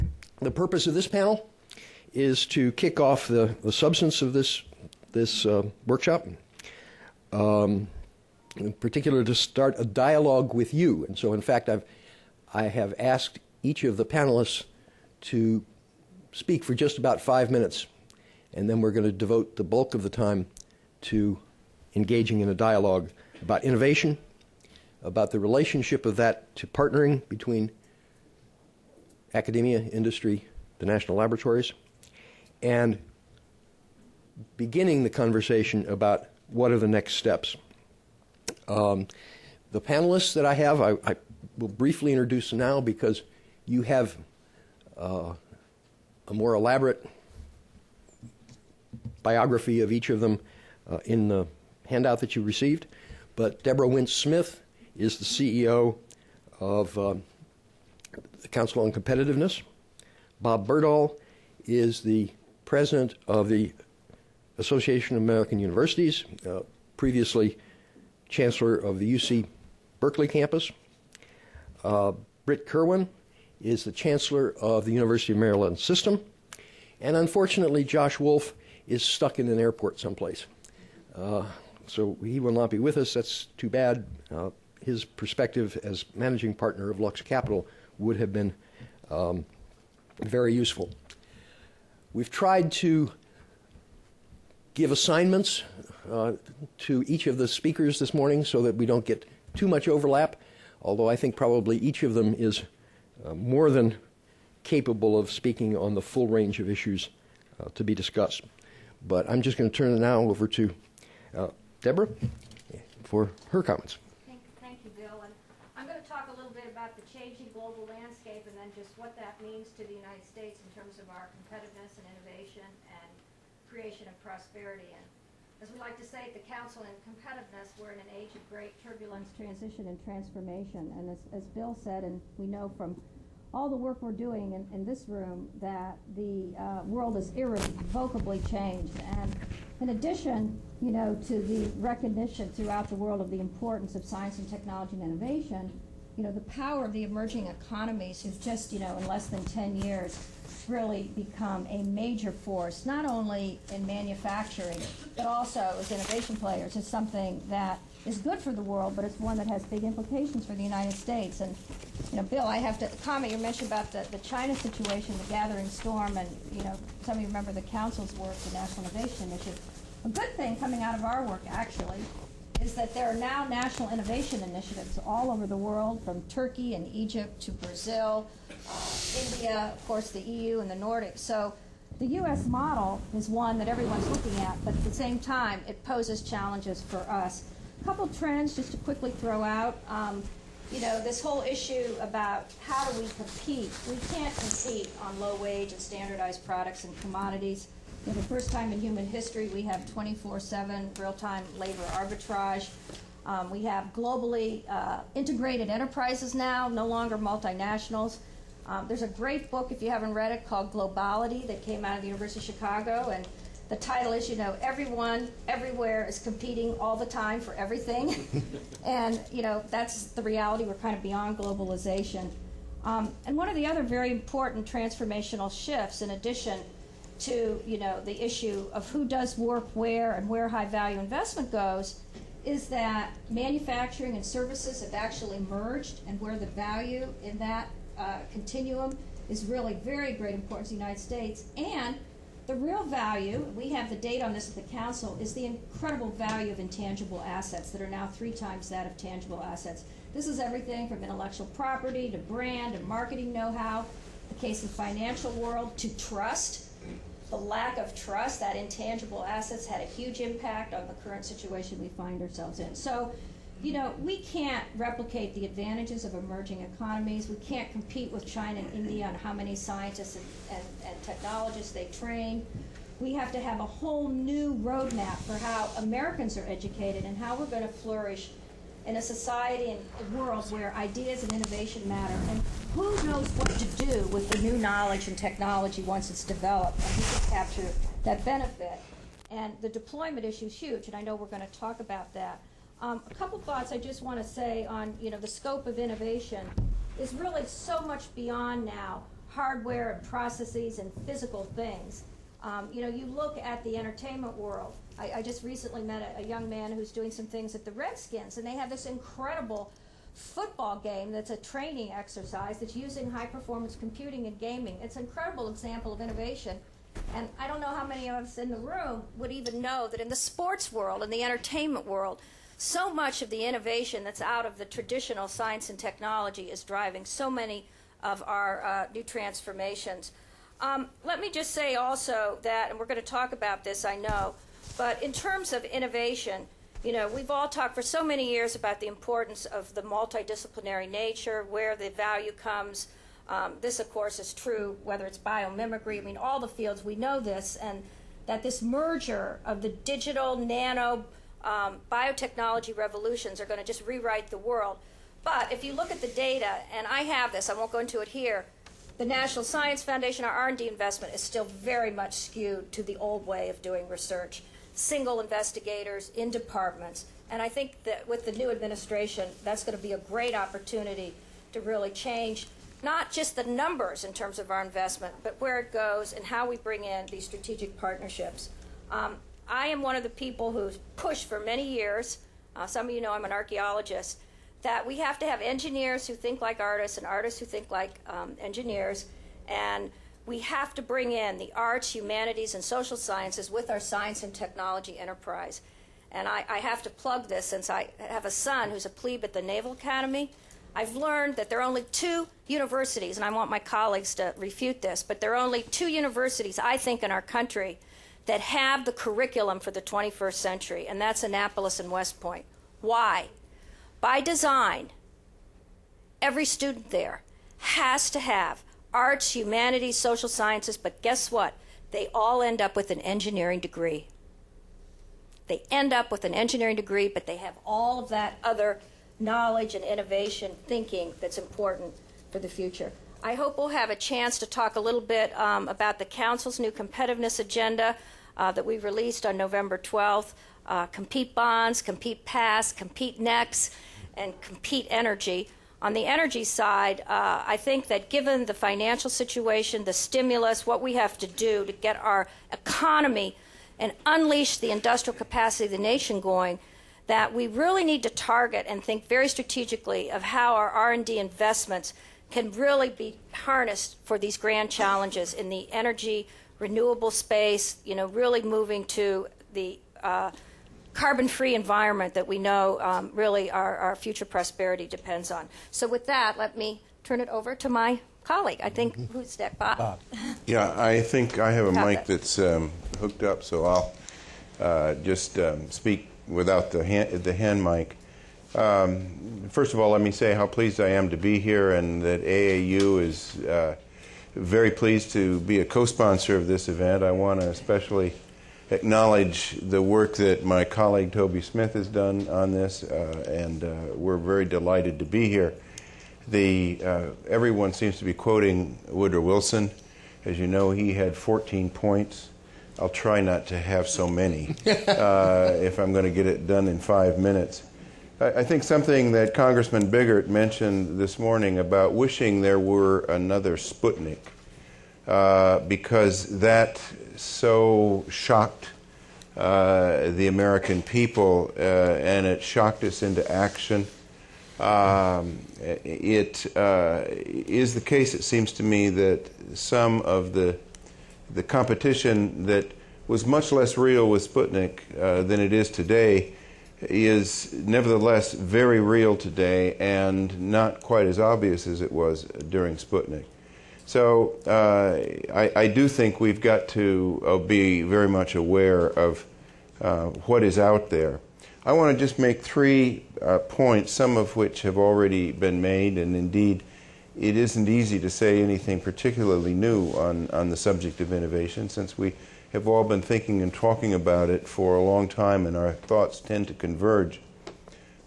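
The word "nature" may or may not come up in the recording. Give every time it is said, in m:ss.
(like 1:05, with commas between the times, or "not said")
5:40.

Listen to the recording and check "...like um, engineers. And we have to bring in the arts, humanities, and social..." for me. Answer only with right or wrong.
right.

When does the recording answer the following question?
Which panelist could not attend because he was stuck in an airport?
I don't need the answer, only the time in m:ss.
1:17.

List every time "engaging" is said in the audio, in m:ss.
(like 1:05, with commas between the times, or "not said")
0:21.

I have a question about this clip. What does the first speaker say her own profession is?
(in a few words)
archaeologist.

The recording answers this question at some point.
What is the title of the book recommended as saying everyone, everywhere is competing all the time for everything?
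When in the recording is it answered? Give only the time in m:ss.
3:30.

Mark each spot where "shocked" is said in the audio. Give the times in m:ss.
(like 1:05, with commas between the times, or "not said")
8:48, 8:52.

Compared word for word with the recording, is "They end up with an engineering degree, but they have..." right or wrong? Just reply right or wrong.
right.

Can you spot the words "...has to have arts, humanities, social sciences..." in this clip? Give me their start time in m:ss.
6:57.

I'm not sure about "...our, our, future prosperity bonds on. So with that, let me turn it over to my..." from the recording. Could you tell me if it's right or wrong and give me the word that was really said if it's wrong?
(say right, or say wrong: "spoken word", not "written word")
wrong: "depends", not "bonds".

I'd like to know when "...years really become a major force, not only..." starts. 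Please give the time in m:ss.
2:29.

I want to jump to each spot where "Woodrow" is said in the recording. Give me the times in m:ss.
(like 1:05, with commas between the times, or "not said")
8:28.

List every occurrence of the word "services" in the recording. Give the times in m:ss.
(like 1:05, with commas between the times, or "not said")
3:54.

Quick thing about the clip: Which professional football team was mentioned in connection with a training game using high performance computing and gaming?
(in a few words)
Redskins.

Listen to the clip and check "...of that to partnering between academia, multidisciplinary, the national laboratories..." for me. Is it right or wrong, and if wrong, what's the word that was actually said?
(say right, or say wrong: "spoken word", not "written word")
wrong: "industry", not "multidisciplinary".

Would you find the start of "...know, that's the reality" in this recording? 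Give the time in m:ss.
3:39.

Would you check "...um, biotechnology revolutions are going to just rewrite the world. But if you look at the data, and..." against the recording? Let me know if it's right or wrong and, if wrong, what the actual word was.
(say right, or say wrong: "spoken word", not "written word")
right.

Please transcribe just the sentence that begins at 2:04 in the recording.
And as we like to say at the Council in Competitiveness, we're in an age of great turbulence, transition, and transformation.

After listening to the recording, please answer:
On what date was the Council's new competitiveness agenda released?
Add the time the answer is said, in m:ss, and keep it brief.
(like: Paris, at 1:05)
November 12, at 7:19.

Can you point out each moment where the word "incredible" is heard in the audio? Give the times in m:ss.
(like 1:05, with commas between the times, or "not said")
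4:05, 5:08, 5:15.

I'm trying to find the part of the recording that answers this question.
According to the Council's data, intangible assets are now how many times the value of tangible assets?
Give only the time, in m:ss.
4:08.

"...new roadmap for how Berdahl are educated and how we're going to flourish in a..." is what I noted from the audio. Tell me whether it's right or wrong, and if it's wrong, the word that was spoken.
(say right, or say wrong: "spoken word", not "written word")
wrong: "Americans", not "Berdahl".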